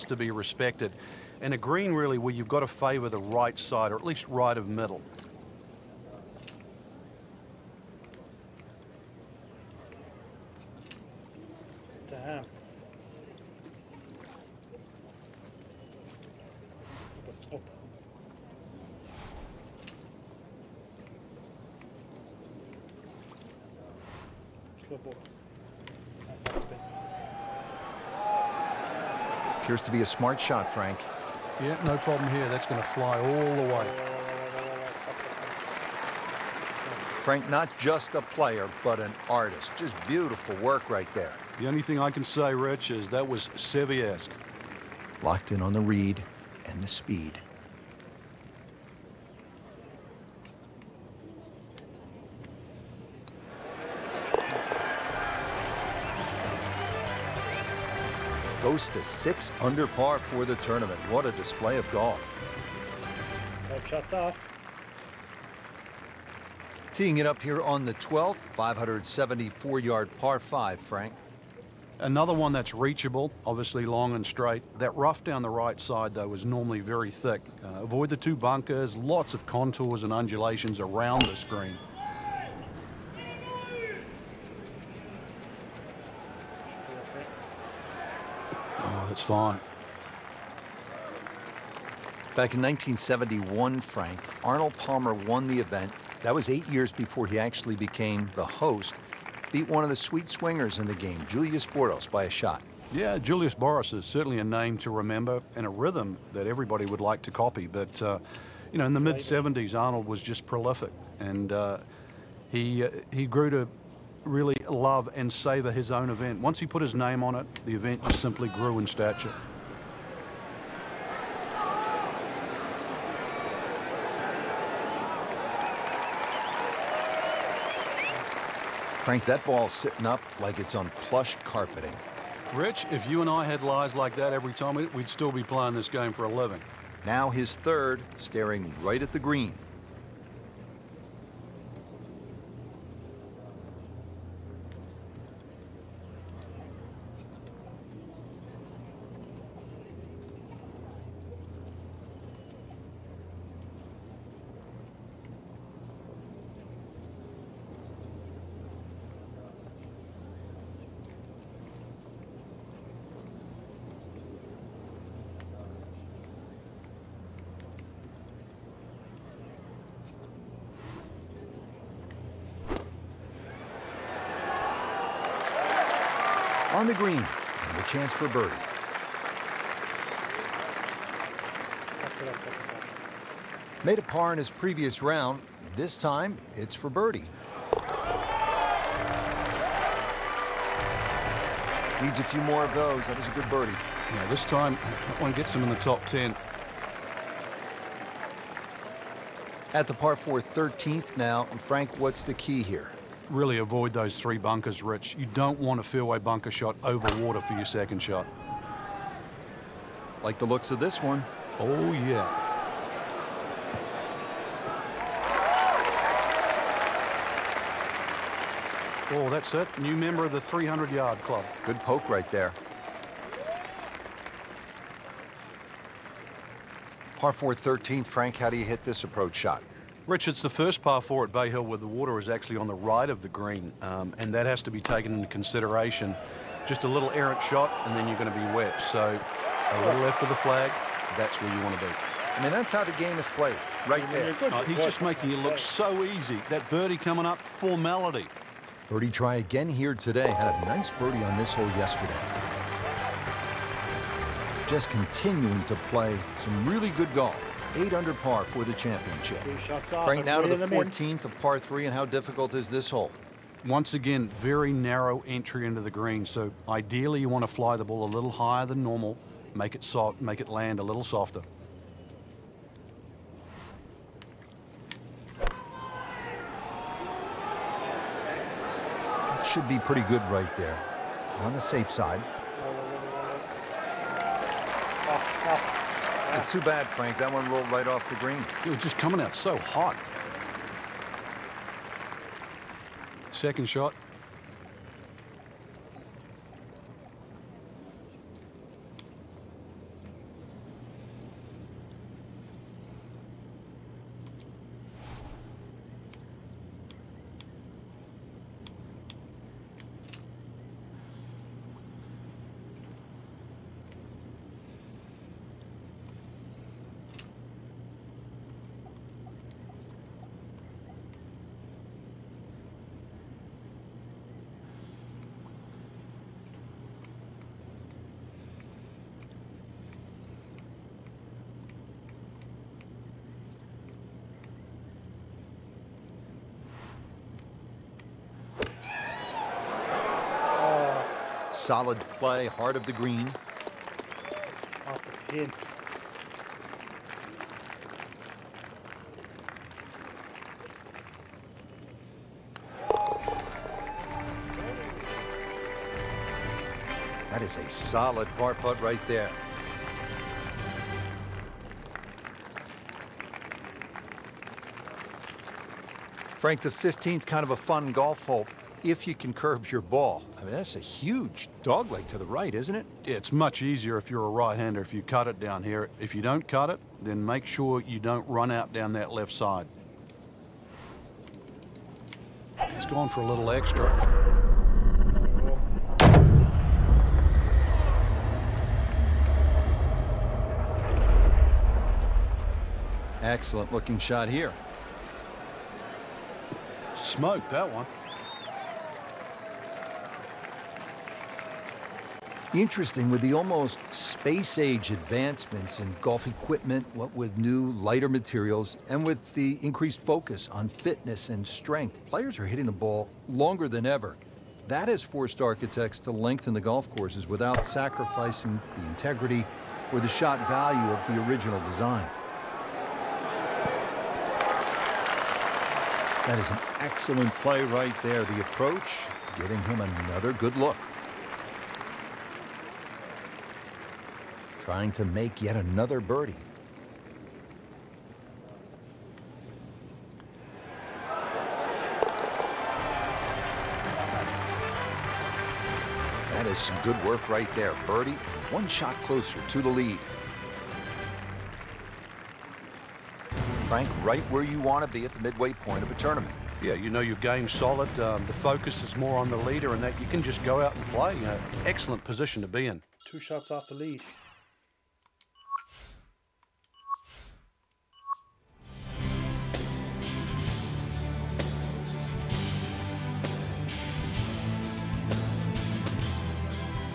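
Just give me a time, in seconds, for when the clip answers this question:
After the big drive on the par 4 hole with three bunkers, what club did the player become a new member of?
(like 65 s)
220 s.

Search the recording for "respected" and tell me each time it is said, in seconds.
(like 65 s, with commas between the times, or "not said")
0 s.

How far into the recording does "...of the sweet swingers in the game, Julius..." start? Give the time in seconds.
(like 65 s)
99 s.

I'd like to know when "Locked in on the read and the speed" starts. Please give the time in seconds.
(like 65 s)
45 s.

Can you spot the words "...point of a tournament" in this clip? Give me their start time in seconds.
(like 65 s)
455 s.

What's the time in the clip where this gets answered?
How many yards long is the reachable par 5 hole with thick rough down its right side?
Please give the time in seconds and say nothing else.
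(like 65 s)
68 s.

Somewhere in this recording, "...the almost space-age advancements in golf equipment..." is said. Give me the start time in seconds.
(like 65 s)
403 s.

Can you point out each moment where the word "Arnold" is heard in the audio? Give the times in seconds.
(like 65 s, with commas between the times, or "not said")
94 s, 109 s.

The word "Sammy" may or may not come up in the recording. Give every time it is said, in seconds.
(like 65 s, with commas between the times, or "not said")
not said.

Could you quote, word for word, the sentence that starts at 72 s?
Another one that's reachable, obviously long and straight.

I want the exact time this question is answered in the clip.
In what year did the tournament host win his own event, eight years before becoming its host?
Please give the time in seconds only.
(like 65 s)
92 s.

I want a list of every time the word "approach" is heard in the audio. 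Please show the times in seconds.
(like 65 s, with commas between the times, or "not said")
229 s, 428 s.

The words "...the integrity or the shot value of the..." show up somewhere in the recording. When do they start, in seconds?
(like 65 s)
418 s.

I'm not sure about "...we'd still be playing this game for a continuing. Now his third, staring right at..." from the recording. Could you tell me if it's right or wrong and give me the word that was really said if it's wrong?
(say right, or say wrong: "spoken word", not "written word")
wrong: "living", not "continuing".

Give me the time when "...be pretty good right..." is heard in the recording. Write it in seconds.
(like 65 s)
279 s.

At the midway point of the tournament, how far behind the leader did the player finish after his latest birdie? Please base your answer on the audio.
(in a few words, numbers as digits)
2 shots.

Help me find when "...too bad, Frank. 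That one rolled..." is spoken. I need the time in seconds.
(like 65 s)
286 s.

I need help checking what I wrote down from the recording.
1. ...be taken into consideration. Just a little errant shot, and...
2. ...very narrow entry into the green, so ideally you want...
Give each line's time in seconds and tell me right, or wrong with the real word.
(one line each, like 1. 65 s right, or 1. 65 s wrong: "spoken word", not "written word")
1. 234 s right
2. 264 s right.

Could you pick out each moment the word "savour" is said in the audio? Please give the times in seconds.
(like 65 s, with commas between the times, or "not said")
115 s.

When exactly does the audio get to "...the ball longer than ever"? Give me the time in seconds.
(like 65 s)
412 s.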